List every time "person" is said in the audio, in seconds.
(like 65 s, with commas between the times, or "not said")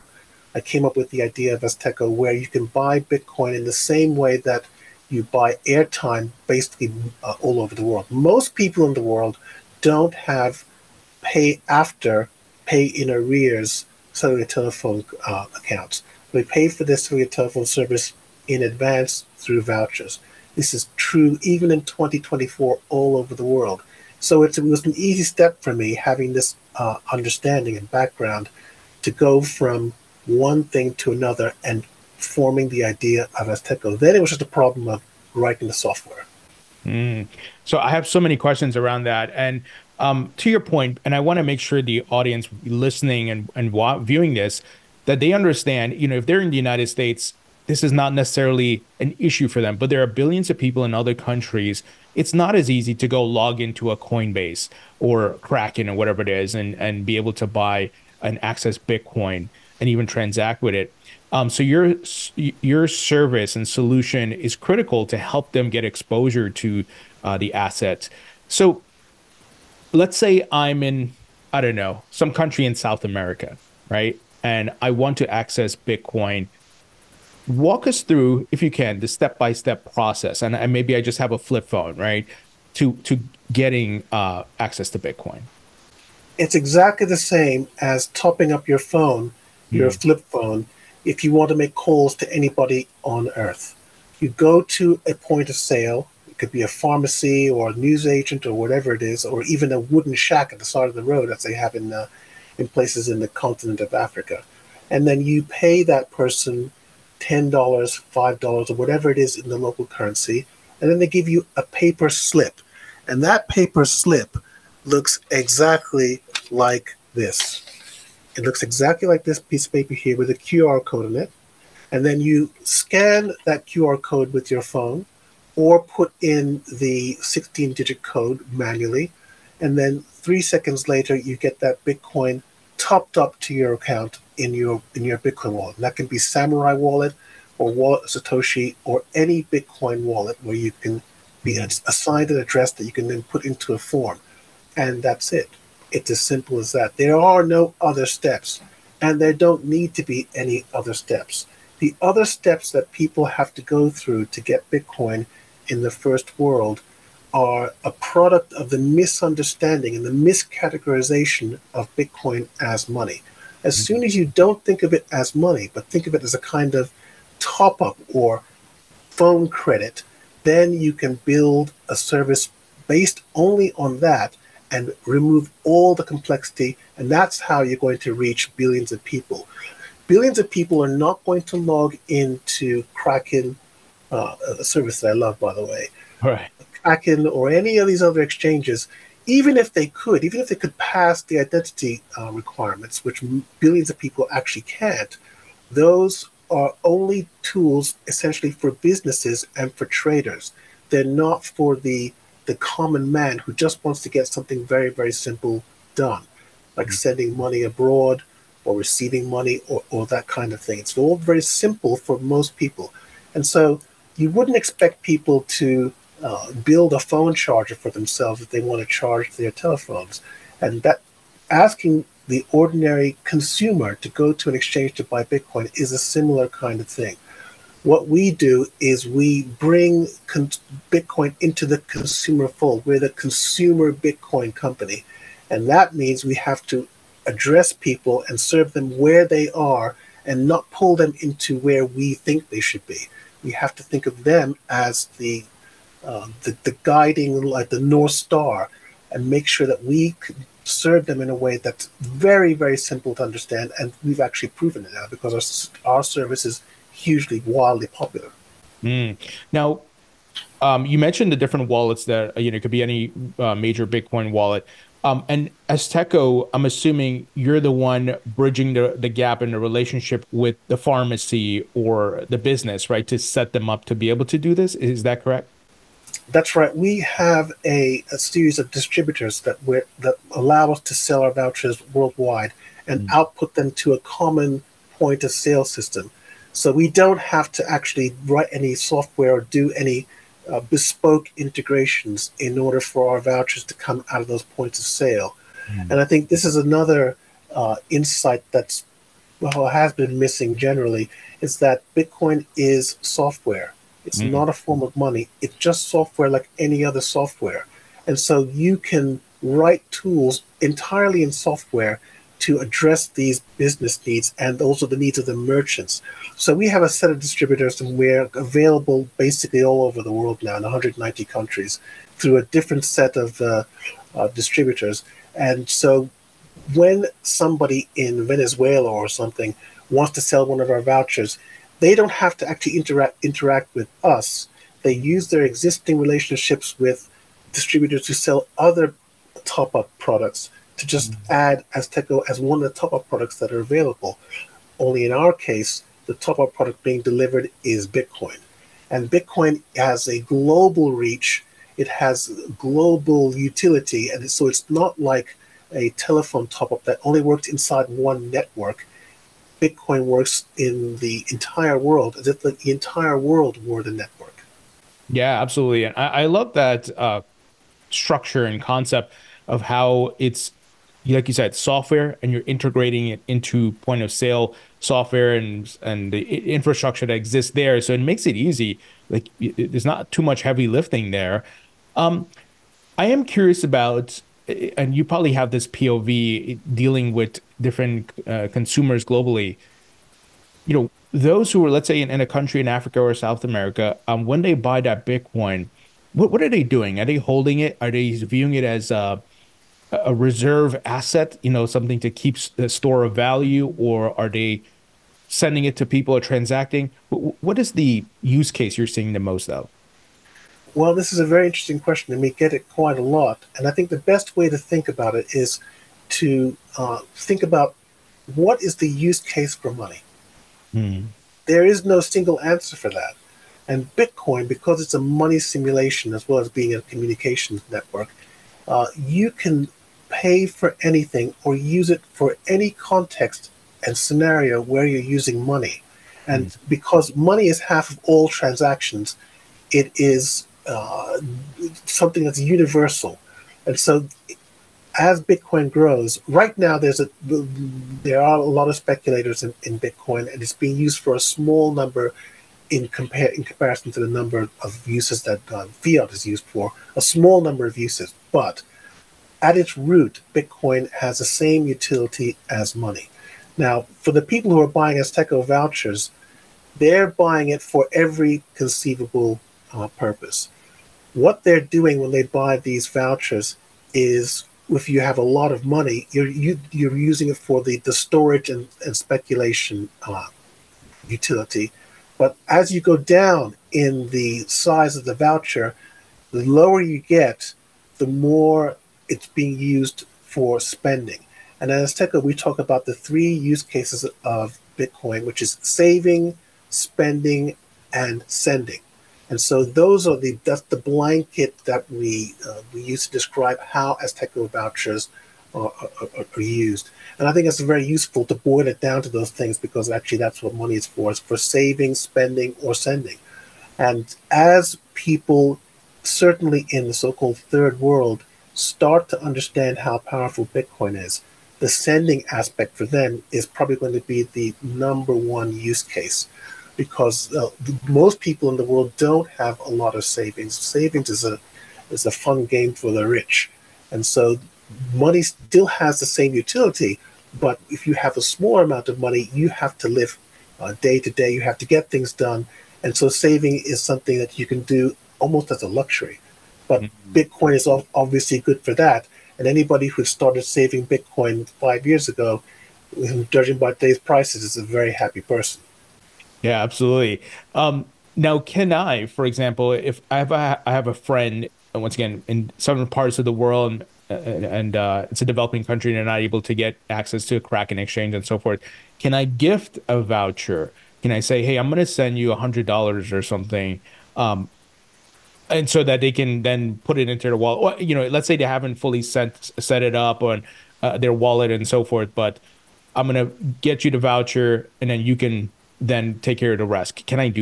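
106 s, 555 s.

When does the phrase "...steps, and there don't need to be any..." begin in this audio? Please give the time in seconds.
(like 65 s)
148 s.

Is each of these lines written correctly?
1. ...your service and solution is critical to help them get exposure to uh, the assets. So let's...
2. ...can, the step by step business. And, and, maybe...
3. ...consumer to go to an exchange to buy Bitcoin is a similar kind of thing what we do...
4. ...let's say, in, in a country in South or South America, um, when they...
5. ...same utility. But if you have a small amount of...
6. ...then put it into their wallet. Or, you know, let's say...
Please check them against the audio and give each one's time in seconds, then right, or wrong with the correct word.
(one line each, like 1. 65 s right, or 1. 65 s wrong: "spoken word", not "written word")
1. 62 s right
2. 78 s wrong: "process", not "business"
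3. 223 s right
4. 391 s wrong: "Africa", not "South"
5. 536 s right
6. 576 s right.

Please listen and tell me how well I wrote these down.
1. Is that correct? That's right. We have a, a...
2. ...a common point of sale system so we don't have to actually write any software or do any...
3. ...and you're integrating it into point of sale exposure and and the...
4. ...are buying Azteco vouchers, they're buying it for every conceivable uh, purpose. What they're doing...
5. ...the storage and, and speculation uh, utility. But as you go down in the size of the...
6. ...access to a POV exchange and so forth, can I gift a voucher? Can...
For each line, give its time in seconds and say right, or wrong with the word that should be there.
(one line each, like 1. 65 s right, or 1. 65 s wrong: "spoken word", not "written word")
1. 274 s right
2. 283 s right
3. 372 s wrong: "software", not "exposure"
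4. 464 s right
5. 477 s right
6. 566 s wrong: "Kraken", not "POV".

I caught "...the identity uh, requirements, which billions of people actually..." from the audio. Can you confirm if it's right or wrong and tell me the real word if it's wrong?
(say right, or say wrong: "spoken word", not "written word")
right.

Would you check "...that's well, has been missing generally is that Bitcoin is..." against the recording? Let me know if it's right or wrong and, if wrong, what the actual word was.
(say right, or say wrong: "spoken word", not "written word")
right.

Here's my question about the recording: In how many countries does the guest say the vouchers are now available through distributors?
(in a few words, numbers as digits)
190.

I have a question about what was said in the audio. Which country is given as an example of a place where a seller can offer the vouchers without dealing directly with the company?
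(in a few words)
Venezuela.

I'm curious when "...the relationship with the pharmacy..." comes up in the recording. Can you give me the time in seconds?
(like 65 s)
269 s.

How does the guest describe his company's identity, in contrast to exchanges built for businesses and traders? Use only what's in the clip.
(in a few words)
the consumer Bitcoin company.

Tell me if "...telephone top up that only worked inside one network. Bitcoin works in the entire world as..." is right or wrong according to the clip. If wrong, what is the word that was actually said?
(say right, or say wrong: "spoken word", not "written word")
right.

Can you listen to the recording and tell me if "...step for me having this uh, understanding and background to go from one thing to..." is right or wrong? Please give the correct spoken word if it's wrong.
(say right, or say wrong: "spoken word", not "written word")
right.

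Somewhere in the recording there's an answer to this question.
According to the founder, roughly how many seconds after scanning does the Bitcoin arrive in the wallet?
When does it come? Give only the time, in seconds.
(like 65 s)
130 s.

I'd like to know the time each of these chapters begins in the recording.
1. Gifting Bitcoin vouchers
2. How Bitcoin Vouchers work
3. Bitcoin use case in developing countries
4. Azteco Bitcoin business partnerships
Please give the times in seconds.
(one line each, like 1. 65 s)
1. 558 s
2. 41 s
3. 382 s
4. 259 s.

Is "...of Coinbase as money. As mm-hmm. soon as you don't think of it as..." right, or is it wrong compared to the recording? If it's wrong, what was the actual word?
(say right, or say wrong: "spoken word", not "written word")
wrong: "Bitcoin", not "Coinbase".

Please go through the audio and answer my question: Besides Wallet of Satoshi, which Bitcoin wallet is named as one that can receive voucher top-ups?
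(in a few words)
Samurai Wallet.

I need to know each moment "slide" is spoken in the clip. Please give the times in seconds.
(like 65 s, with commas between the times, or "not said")
not said.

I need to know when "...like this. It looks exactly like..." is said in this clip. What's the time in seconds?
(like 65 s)
116 s.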